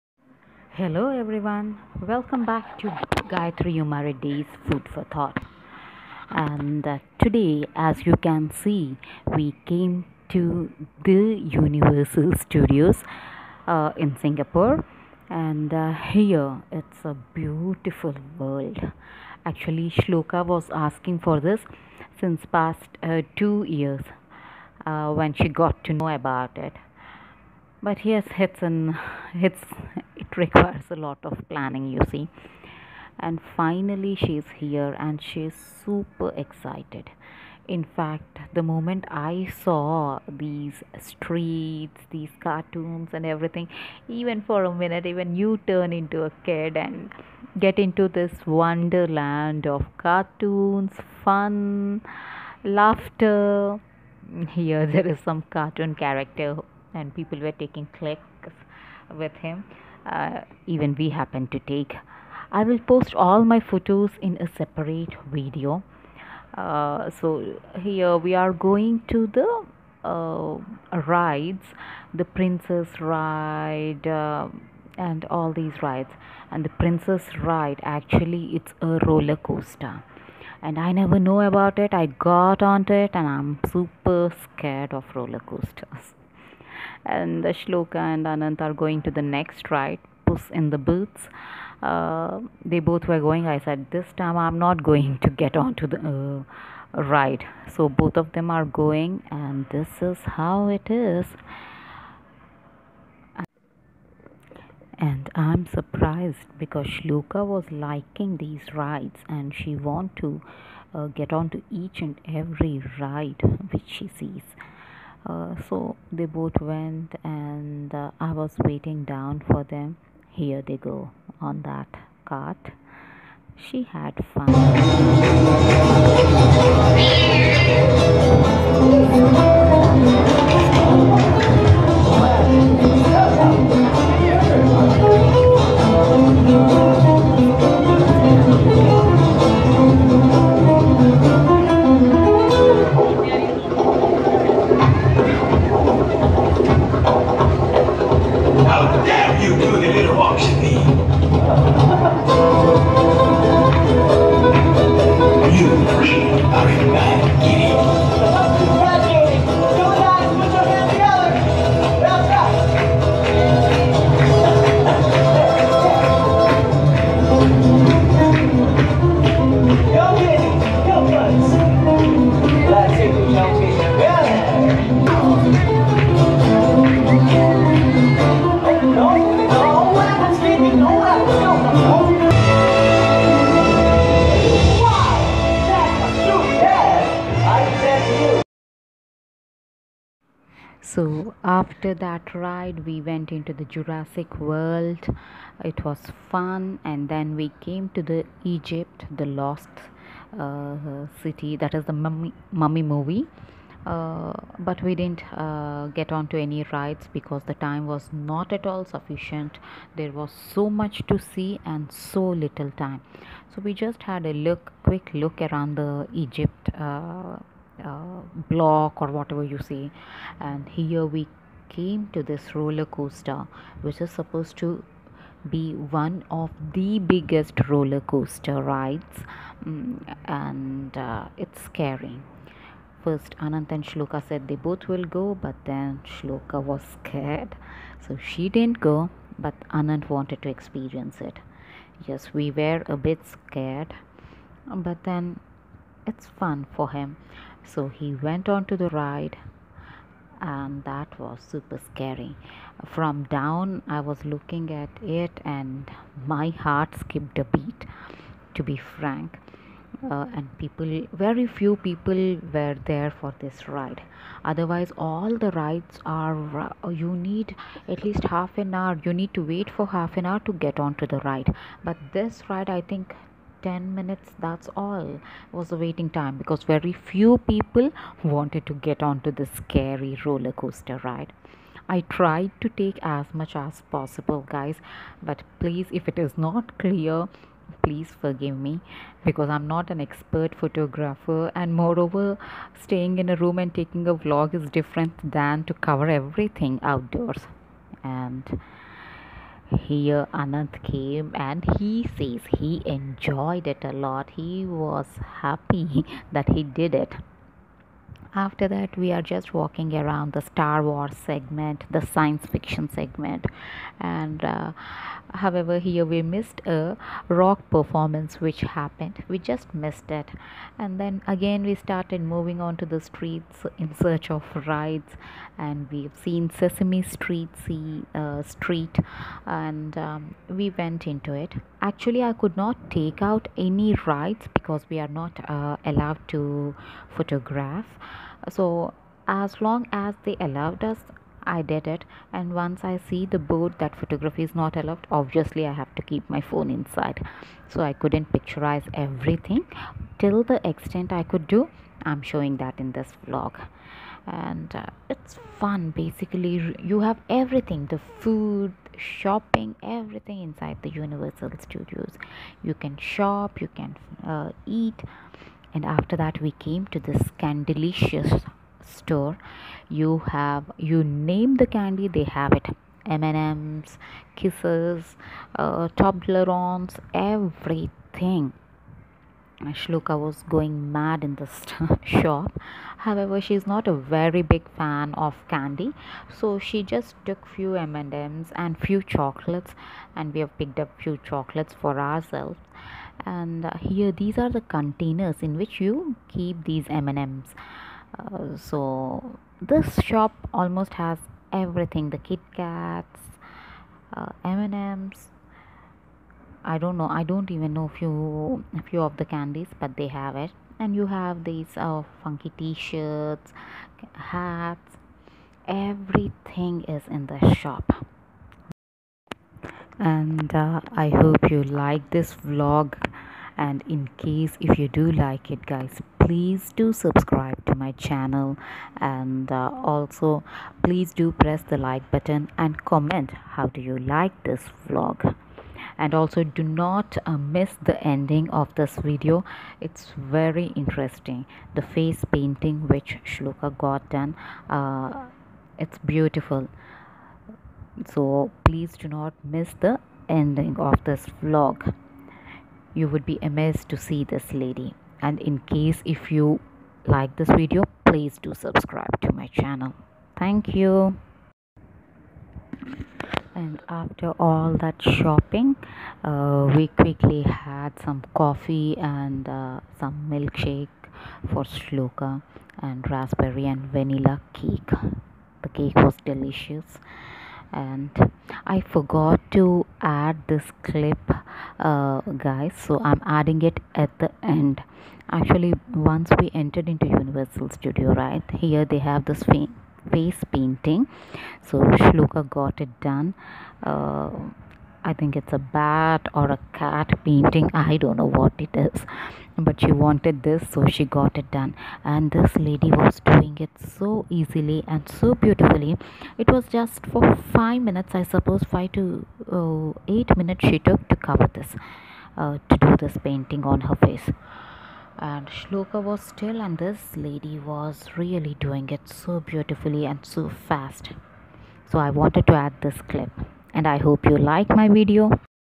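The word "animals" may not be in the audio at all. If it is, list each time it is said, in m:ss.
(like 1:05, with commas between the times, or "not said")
not said.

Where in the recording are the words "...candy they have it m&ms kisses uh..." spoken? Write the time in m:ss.
6:11.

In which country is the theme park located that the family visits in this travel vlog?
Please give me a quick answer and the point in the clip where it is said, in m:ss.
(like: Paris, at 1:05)
Singapore, at 0:14.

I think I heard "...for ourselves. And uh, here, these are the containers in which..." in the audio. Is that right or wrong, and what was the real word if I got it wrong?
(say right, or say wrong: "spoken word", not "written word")
right.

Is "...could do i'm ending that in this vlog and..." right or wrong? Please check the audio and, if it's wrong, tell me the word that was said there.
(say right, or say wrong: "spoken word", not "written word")
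wrong: "showing", not "ending".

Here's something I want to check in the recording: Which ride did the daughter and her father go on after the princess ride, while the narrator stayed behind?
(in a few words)
Puss in the Boots.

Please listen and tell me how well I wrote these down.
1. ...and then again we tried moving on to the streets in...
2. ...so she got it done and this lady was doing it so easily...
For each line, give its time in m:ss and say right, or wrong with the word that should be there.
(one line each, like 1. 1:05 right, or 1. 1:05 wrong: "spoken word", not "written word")
1. 5:20 wrong: "started", not "tried"
2. 8:20 right.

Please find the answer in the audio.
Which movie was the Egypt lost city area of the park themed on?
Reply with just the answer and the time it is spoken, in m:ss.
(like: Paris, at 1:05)
The Mummy, at 3:22.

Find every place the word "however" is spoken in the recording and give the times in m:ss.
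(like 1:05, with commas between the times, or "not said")
5:15, 6:22.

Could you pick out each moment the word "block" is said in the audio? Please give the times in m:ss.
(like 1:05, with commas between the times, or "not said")
3:38.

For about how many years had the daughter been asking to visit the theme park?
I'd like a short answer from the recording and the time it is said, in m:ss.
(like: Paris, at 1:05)
2, at 0:23.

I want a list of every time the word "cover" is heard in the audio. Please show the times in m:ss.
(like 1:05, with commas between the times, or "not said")
4:55, 8:31.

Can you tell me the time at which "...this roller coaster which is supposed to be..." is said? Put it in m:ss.
3:42.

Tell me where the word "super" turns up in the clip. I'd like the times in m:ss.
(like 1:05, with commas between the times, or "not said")
0:35, 1:23, 4:11.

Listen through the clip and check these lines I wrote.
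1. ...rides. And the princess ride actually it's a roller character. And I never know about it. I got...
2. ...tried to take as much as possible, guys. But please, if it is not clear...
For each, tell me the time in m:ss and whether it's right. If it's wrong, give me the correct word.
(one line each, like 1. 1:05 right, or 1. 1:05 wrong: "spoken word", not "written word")
1. 1:15 wrong: "coaster", not "character"
2. 4:42 right.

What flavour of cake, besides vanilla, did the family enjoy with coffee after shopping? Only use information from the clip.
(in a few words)
Raspberry.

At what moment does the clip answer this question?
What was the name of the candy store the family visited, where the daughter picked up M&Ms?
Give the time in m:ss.
6:07.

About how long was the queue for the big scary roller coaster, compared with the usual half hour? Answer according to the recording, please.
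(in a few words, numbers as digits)
10 minutes.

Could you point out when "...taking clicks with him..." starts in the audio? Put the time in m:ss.
0:57.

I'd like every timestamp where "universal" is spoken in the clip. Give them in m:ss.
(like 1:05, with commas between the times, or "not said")
0:11, 6:00, 8:07.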